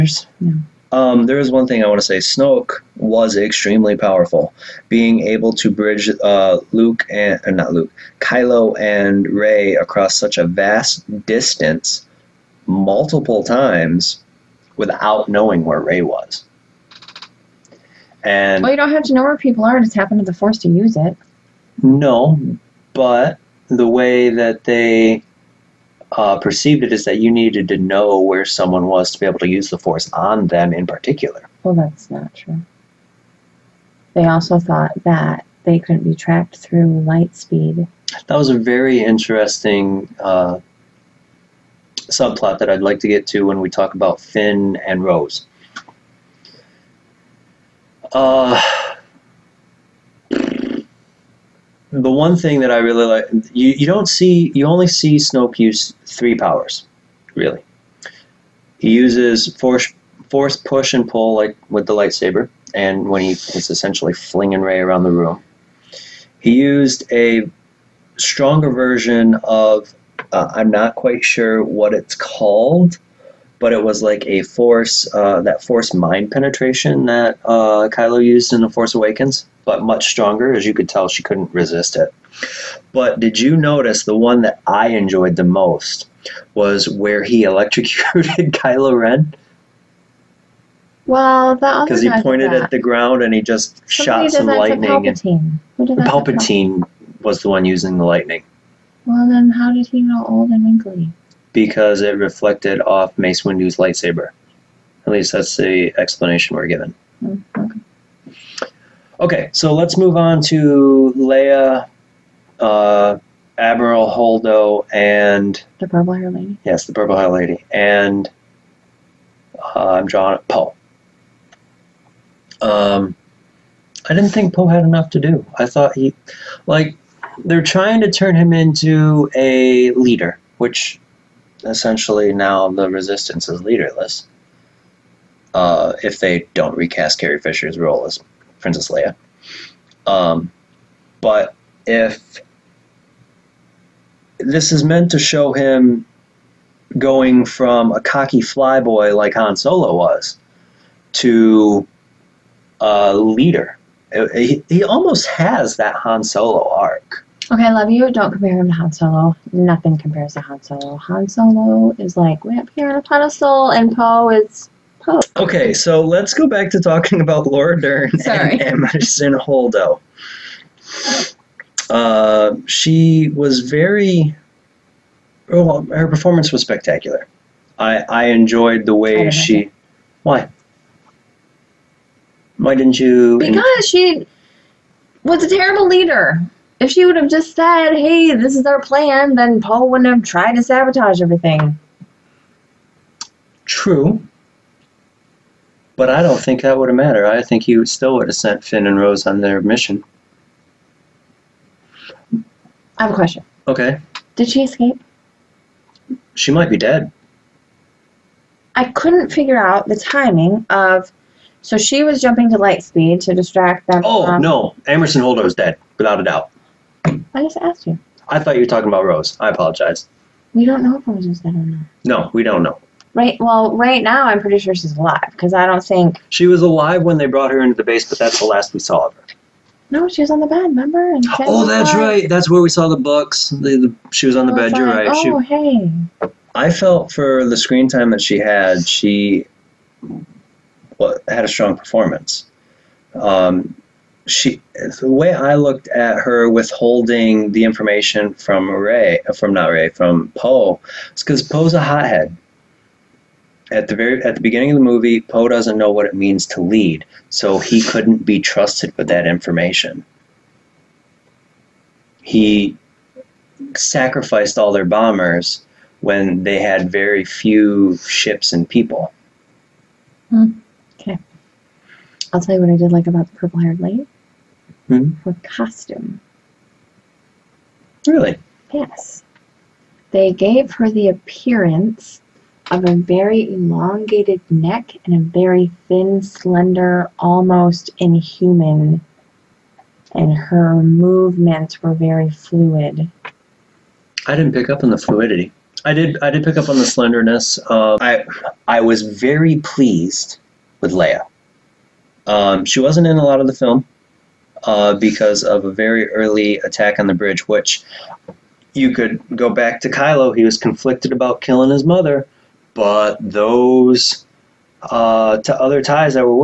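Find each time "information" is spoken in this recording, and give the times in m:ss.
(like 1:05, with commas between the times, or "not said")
4:07, 4:19.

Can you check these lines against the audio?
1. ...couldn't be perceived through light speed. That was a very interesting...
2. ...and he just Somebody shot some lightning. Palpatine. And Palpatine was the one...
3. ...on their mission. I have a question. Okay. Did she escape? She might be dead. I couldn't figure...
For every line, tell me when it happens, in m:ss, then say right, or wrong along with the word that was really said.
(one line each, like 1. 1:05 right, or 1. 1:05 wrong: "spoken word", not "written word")
1. 0:35 wrong: "tracked", not "perceived"
2. 1:33 right
3. 3:19 right.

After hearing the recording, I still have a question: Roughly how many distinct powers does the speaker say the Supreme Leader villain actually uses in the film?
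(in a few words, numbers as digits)
3.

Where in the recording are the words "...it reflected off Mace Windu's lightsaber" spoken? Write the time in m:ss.
1:42.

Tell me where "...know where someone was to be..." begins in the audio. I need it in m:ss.
0:27.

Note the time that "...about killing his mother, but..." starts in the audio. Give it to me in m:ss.
5:11.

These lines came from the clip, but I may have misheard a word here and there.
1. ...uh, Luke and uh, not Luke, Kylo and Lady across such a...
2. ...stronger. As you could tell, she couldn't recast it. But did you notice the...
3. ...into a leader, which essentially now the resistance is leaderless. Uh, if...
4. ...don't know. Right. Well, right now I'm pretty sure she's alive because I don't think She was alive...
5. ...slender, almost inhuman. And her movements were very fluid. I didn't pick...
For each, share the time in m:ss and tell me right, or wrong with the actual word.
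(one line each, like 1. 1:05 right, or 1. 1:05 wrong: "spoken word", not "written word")
1. 0:06 wrong: "Rey", not "Lady"
2. 1:20 wrong: "resist", not "recast"
3. 2:08 right
4. 3:42 right
5. 4:46 right.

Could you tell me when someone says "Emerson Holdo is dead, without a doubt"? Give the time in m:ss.
3:34.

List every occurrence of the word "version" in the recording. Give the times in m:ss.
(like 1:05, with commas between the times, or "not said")
1:08.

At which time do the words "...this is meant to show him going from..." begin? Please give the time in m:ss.
2:24.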